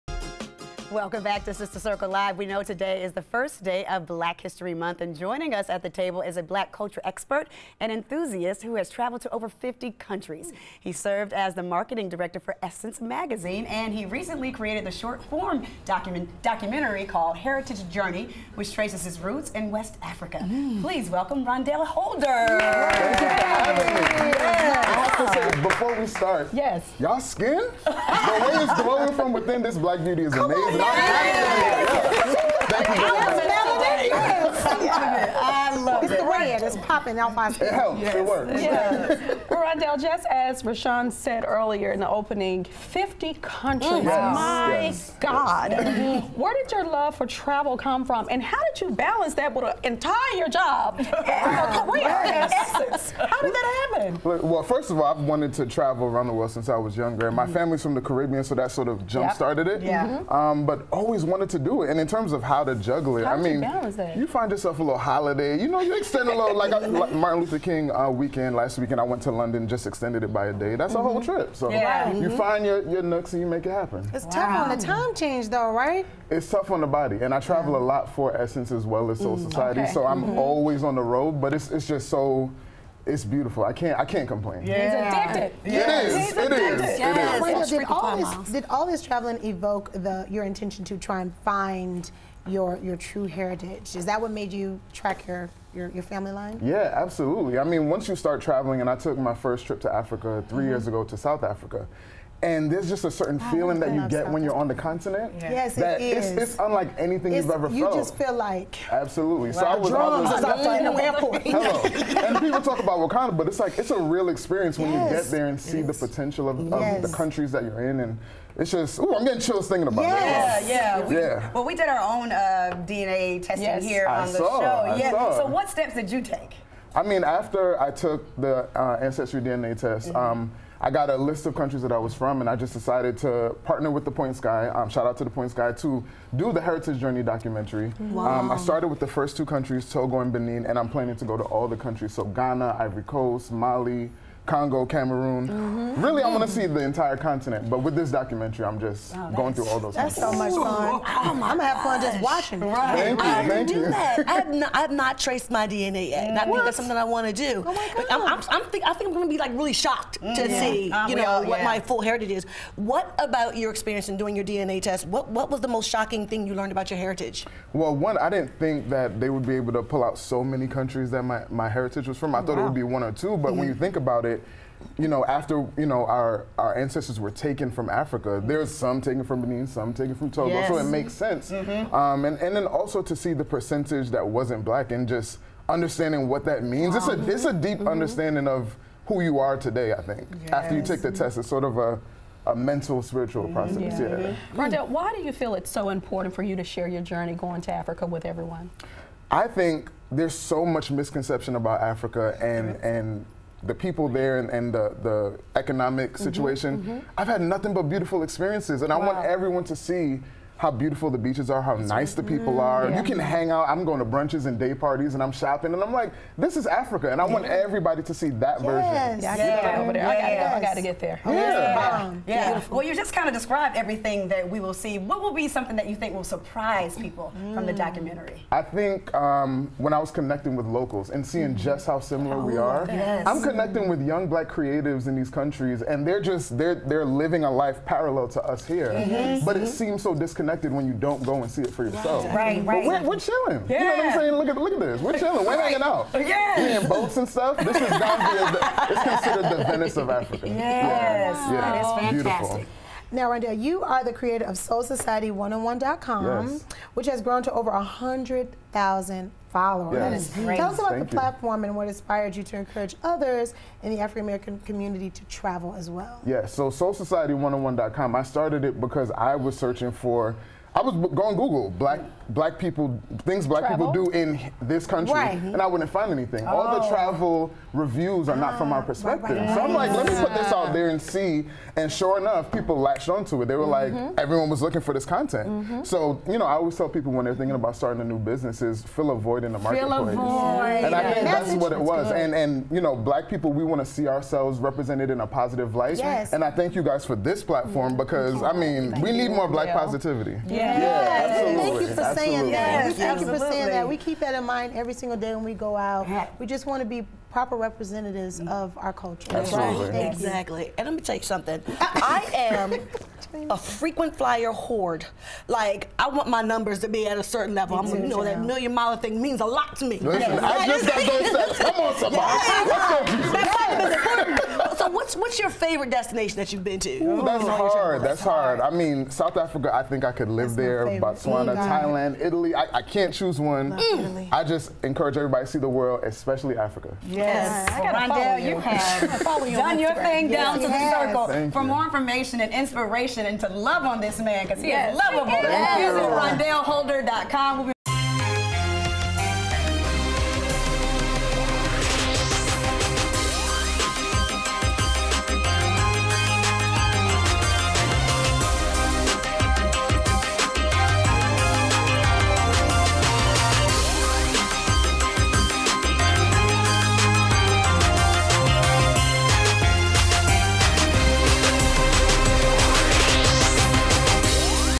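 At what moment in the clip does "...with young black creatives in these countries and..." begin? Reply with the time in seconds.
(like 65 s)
233 s.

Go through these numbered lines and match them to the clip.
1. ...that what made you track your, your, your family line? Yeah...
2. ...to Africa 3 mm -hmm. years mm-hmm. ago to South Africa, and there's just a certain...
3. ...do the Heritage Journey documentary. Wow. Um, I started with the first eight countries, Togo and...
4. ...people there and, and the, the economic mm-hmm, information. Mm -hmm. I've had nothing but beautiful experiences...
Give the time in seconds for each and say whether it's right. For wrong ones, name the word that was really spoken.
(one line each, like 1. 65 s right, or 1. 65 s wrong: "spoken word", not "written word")
1. 94 s right
2. 99 s right
3. 136 s wrong: "two", not "eight"
4. 203 s wrong: "situation", not "information".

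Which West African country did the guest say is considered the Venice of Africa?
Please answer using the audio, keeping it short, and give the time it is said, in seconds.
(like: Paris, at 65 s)
Gambia, at 247 s.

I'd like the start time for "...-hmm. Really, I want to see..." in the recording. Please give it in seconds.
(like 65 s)
145 s.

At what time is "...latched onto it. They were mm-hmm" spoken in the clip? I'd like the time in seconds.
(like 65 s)
282 s.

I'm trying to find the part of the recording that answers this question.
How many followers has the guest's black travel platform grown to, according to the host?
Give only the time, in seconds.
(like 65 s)
257 s.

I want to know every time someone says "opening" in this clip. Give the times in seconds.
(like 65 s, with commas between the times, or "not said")
42 s.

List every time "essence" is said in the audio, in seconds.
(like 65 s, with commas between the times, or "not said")
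12 s, 52 s, 78 s.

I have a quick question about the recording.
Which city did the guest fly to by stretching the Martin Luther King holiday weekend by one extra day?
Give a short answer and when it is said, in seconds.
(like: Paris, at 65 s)
London, at 69 s.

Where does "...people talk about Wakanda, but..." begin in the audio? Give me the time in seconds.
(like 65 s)
112 s.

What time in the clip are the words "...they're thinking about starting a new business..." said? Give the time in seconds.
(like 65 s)
287 s.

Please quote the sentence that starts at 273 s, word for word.
people do in this country, right.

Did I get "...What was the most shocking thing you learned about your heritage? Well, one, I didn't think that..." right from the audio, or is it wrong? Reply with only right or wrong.
right.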